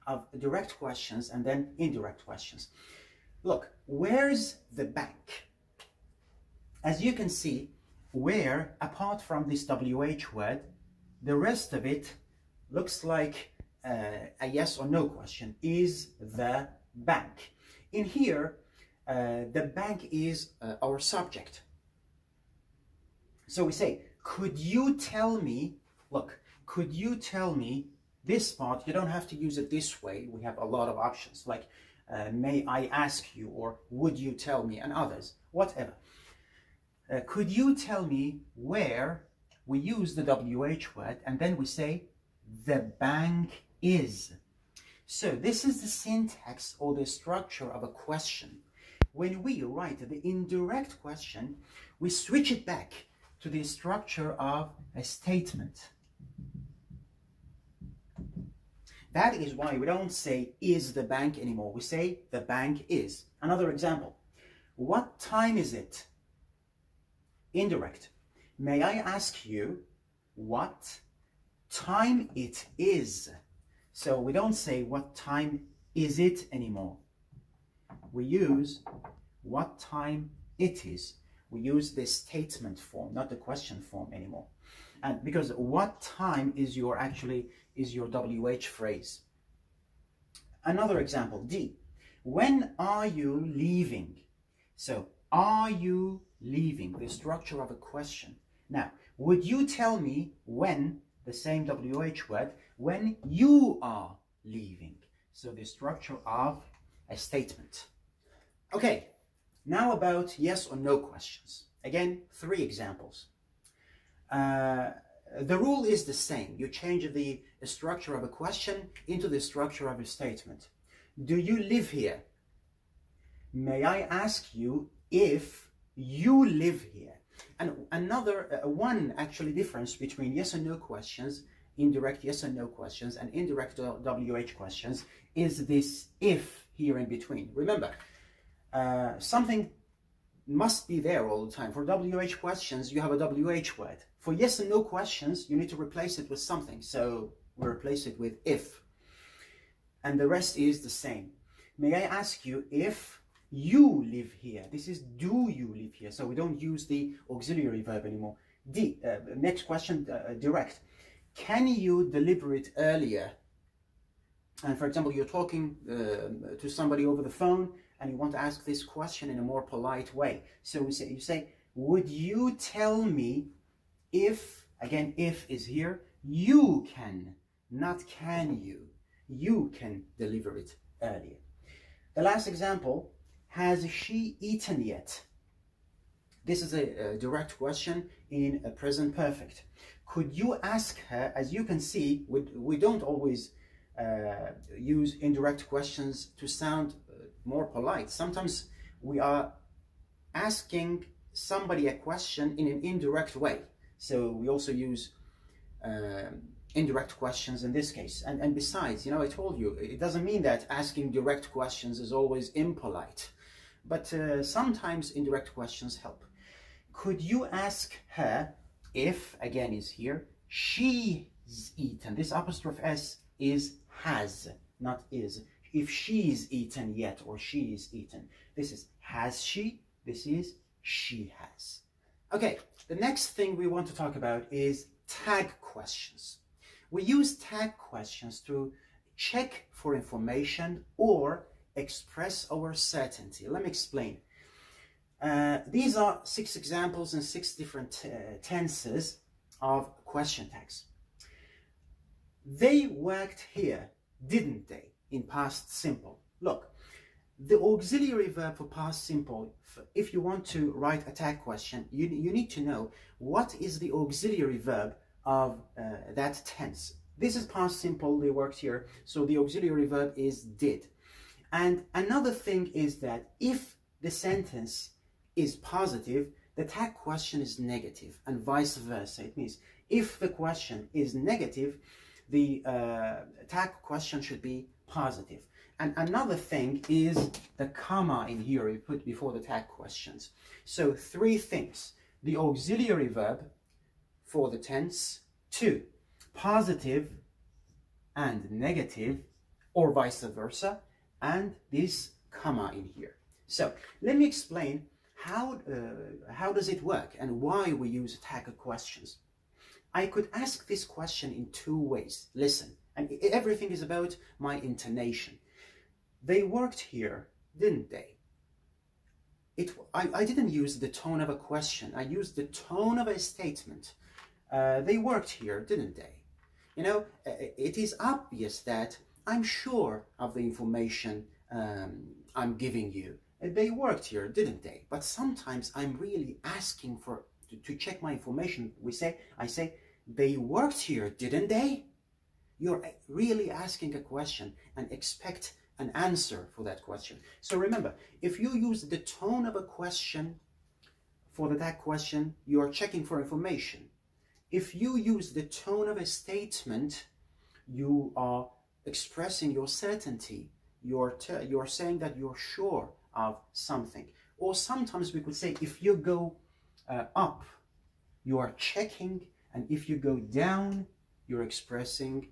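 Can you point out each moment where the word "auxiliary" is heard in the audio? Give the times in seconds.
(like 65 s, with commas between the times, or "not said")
157 s, 257 s, 263 s, 269 s, 292 s.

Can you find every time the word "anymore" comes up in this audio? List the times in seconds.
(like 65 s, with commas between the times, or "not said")
61 s, 76 s, 84 s, 158 s.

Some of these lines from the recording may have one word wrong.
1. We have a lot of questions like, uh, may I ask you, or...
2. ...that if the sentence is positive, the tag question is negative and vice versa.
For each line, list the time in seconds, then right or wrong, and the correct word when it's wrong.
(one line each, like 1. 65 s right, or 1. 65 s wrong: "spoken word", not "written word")
1. 30 s wrong: "options", not "questions"
2. 272 s right.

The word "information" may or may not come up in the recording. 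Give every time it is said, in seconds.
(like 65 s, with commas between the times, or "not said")
239 s, 330 s, 338 s, 353 s.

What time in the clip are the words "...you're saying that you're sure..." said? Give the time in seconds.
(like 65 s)
361 s.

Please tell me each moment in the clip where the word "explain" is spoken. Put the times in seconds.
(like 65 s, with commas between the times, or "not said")
243 s, 304 s.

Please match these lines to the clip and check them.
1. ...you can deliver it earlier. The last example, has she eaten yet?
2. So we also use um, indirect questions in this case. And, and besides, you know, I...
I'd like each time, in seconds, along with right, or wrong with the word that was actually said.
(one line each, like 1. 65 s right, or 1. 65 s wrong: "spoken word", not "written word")
1. 179 s right
2. 203 s right.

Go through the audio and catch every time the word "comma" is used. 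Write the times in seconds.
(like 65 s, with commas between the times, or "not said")
287 s, 302 s.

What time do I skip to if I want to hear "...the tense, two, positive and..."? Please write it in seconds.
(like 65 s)
294 s.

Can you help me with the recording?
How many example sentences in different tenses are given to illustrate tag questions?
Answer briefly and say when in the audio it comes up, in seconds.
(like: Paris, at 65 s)
6, at 246 s.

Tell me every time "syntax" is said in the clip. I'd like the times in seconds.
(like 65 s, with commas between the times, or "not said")
45 s.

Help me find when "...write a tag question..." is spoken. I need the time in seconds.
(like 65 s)
260 s.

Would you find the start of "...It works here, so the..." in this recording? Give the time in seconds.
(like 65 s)
268 s.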